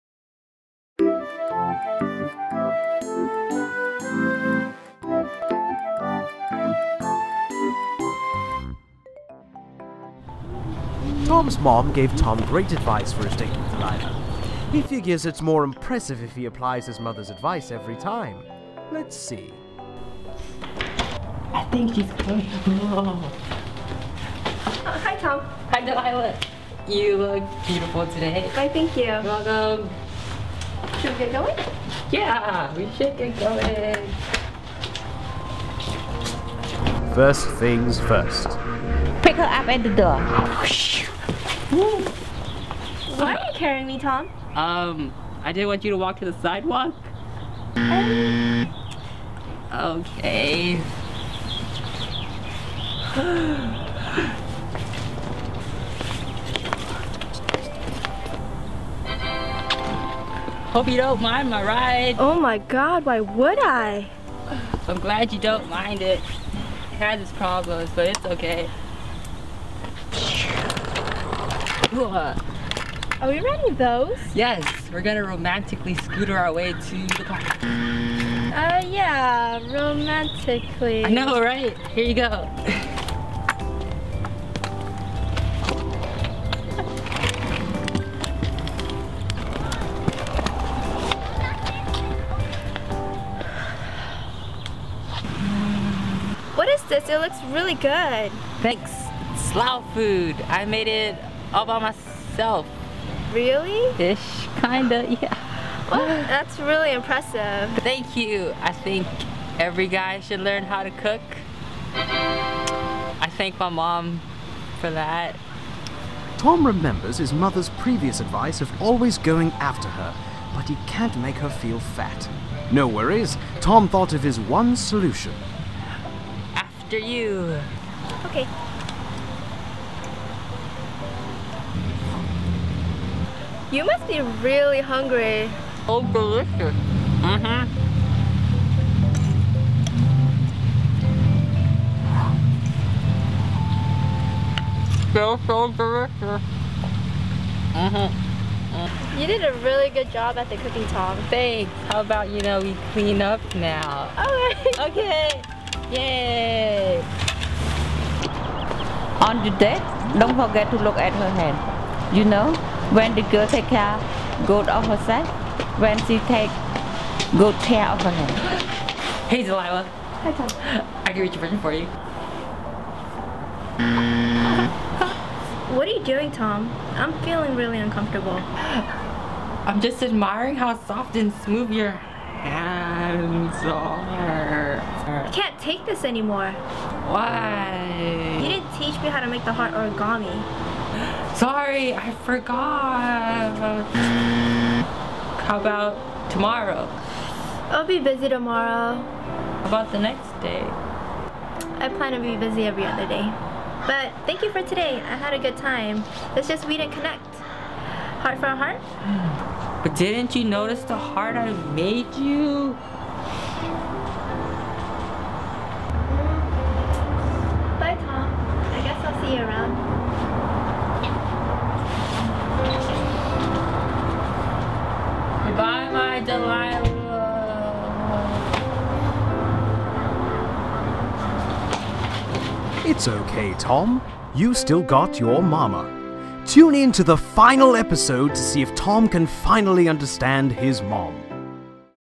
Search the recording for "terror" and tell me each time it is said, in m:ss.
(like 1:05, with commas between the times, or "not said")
not said.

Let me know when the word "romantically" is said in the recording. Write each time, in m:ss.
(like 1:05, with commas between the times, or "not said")
1:15, 1:19.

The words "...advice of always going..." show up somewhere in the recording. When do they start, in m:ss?
1:58.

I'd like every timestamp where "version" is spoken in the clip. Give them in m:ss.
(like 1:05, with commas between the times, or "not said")
2:51.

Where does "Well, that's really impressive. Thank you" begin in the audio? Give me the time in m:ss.
1:45.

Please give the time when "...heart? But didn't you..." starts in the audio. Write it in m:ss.
3:28.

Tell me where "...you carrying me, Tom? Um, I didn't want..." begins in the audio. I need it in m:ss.
0:43.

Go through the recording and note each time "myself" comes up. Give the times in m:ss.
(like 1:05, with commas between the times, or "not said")
1:41.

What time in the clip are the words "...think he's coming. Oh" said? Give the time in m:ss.
0:21.